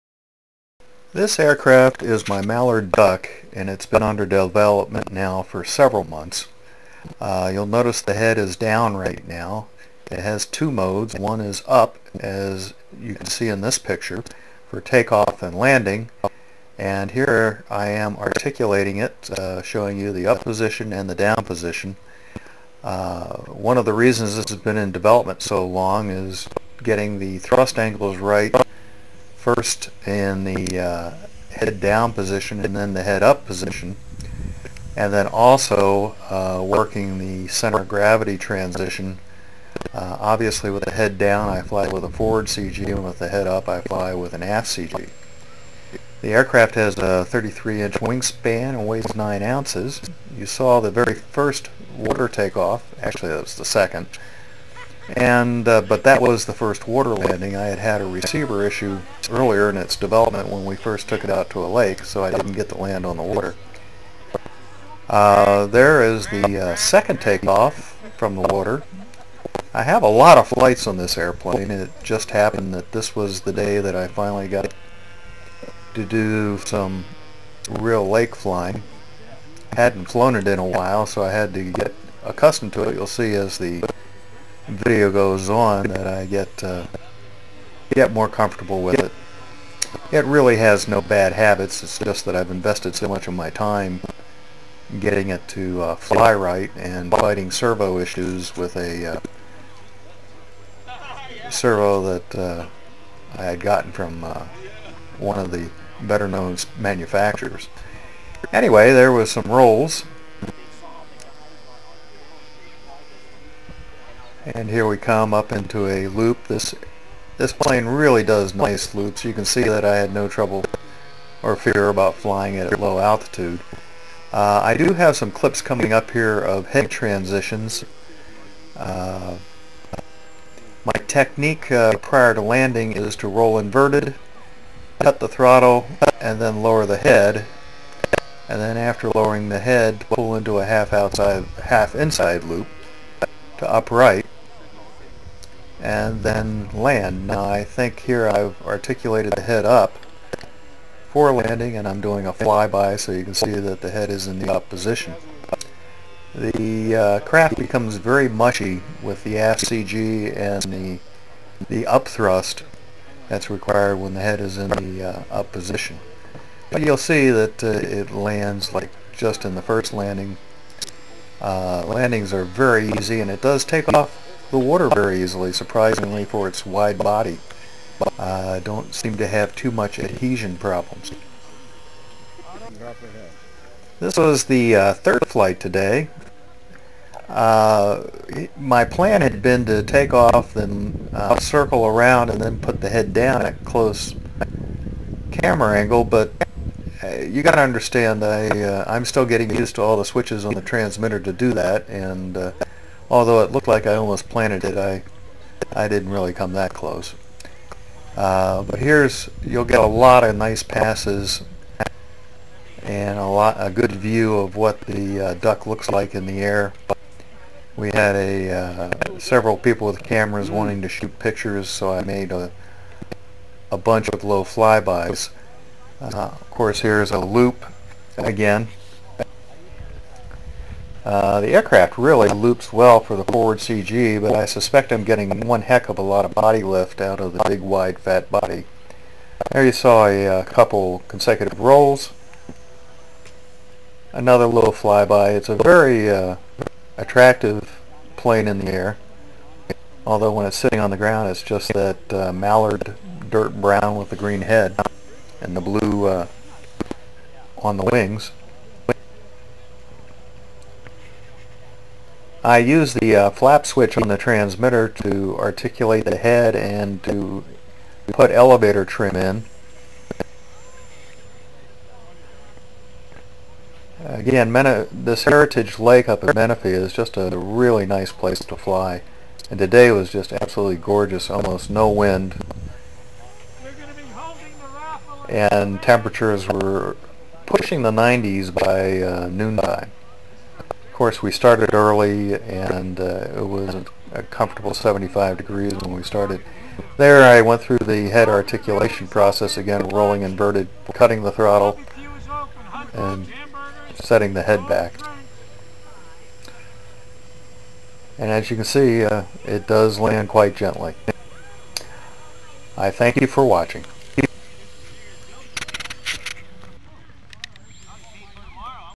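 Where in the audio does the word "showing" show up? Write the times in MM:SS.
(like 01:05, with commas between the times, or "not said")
00:19.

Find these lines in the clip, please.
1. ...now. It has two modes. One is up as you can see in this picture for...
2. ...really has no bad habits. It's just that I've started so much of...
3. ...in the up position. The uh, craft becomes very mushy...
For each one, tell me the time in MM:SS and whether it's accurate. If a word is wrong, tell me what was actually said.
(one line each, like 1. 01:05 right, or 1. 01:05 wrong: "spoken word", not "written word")
1. 00:09 right
2. 01:30 wrong: "invested", not "started"
3. 02:34 right.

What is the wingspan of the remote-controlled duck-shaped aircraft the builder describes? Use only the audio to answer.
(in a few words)
33 inches.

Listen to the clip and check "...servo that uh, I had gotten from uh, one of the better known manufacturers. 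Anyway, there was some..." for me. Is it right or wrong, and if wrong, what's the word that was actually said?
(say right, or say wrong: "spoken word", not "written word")
right.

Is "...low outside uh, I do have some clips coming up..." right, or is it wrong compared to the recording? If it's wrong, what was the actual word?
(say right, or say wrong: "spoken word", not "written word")
wrong: "altitude", not "outside".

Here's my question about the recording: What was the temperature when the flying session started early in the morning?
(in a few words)
75 degrees.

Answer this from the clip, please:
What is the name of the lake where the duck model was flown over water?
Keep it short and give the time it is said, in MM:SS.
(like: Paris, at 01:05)
Heritage Lake, at 04:35.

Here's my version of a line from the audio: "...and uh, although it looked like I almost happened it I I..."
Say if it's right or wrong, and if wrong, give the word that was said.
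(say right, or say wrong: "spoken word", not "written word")
wrong: "planted", not "happened".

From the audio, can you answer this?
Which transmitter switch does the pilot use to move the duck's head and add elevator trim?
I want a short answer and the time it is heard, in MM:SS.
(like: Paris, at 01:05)
flap switch, at 04:23.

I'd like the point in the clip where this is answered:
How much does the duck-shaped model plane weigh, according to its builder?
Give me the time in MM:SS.
00:49.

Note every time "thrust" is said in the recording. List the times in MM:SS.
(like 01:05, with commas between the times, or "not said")
00:27, 02:42.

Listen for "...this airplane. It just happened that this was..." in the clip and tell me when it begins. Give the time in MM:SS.
01:10.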